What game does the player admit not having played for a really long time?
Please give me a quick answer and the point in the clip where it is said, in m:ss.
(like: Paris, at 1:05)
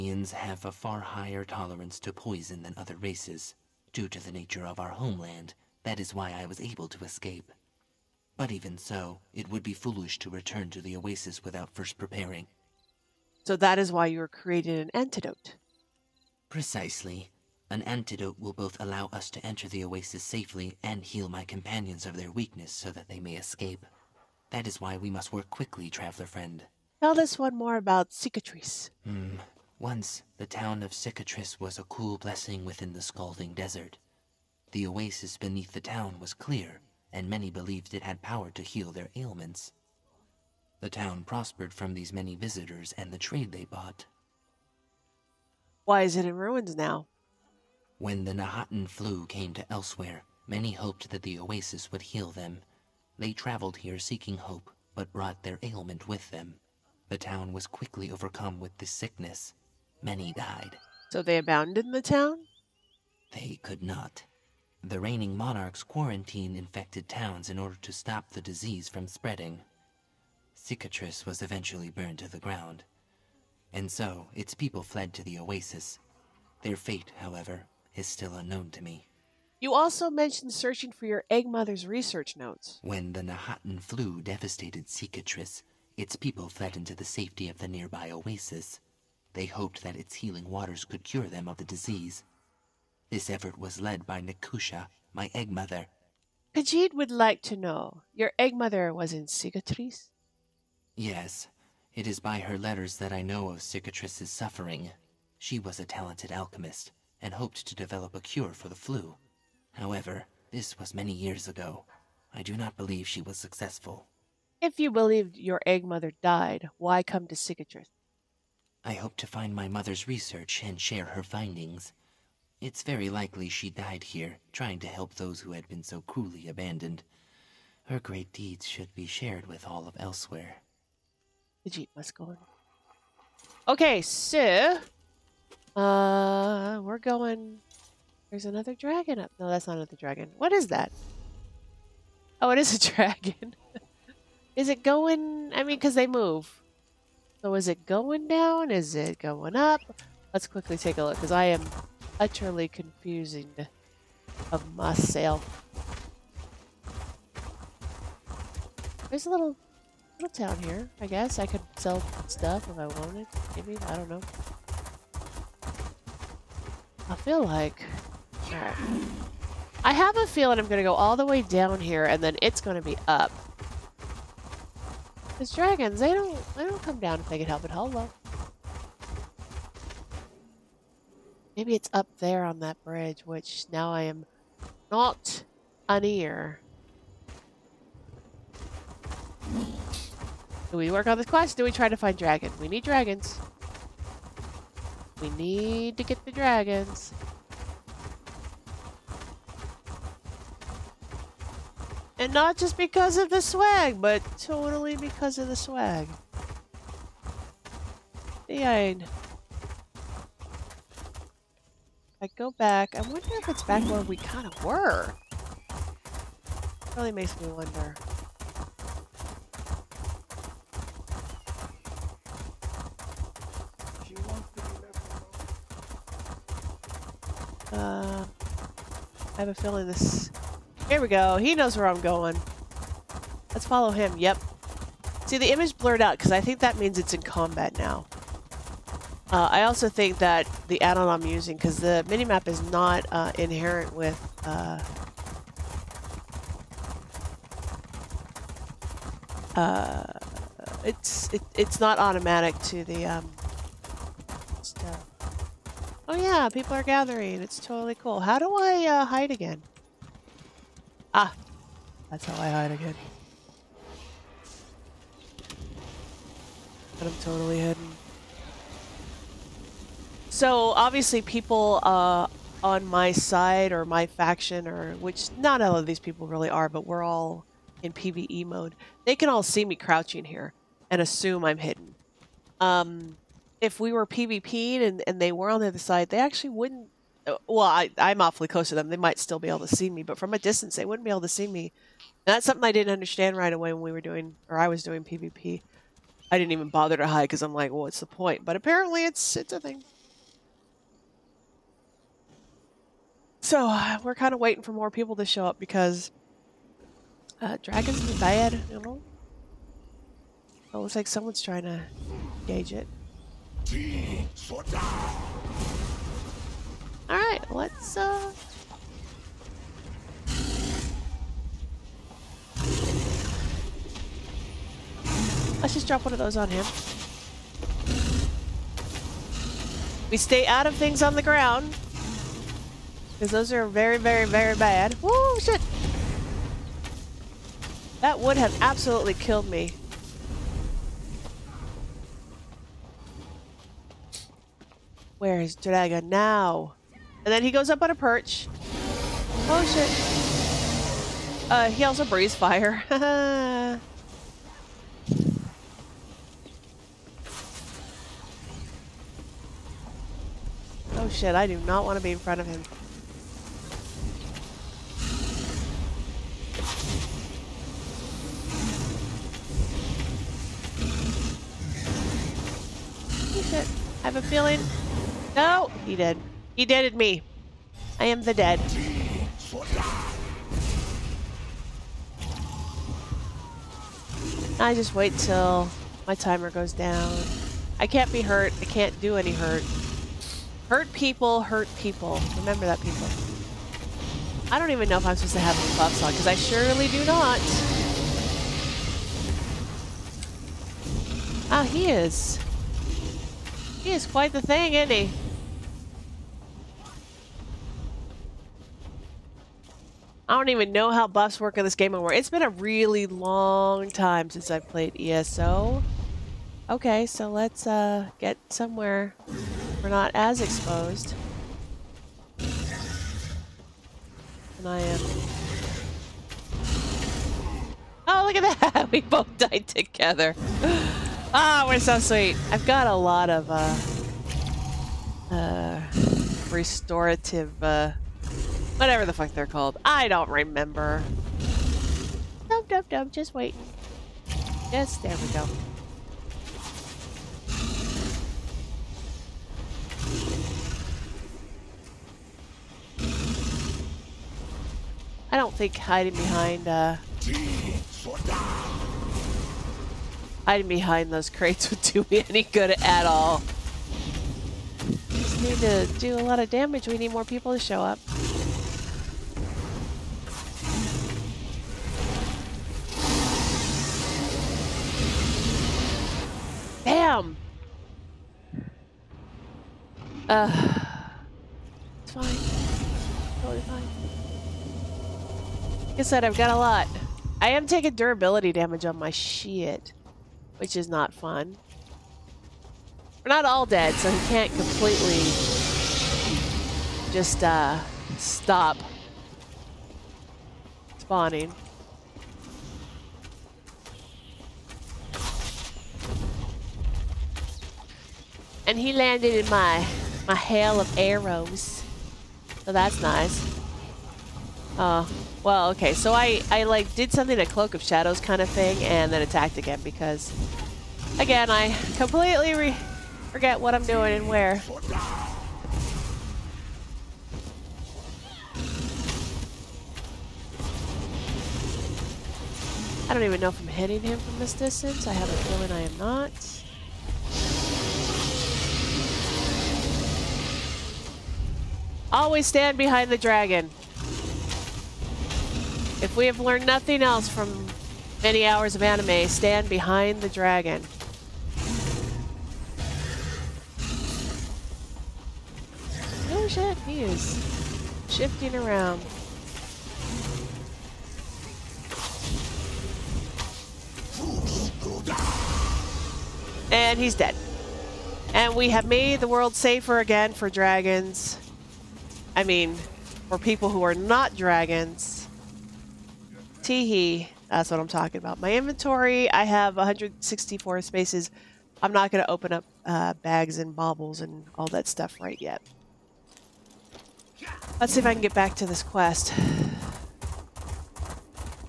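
ESO, at 6:54.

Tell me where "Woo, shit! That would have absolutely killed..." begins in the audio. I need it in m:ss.
5:35.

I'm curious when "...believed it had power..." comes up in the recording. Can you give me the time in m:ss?
0:37.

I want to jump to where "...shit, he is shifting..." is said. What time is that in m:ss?
9:16.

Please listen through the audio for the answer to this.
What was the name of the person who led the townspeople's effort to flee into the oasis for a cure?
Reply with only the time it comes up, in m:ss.
1:34.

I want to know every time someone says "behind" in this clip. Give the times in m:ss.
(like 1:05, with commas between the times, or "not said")
7:36, 7:40, 9:02, 9:09.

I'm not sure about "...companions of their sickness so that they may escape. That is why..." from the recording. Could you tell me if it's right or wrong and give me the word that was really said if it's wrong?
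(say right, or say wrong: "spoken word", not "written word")
wrong: "weakness", not "sickness".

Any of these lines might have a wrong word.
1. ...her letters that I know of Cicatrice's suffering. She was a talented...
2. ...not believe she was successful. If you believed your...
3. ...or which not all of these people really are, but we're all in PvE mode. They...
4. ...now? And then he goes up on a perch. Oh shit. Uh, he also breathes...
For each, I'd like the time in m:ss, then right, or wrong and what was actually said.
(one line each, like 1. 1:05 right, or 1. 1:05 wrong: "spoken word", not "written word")
1. 1:42 right
2. 1:52 right
3. 4:34 right
4. 5:46 right.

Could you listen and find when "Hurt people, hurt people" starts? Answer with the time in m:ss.
6:30.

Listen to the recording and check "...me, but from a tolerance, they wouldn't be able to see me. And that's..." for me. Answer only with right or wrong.
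wrong.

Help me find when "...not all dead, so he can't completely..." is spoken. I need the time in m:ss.
8:13.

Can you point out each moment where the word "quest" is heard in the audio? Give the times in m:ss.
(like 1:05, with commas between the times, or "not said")
3:11, 9:48.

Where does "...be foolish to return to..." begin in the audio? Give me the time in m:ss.
0:09.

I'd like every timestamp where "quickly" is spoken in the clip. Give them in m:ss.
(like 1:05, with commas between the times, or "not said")
0:25, 0:57, 2:30.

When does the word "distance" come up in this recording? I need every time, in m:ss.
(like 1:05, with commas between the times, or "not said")
4:50, 8:54.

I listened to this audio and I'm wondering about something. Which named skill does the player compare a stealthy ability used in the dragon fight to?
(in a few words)
Cloak of Shadows.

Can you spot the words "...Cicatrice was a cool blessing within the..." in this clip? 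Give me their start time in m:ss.
0:30.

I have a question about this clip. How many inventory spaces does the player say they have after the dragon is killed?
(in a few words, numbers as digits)
164.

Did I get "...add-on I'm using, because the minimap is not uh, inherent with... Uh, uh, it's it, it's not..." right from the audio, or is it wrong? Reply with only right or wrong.
right.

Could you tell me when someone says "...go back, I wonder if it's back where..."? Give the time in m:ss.
3:32.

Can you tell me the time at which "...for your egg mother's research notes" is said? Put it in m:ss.
1:20.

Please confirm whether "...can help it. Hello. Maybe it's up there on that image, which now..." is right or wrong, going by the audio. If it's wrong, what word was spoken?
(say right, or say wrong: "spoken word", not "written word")
wrong: "bridge", not "image".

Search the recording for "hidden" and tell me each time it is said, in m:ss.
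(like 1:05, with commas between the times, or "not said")
4:27, 4:41.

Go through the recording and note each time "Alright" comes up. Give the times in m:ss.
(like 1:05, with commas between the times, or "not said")
2:48, 5:17.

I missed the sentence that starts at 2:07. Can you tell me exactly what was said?
Her great deeds should be shared with all of Elsweyr.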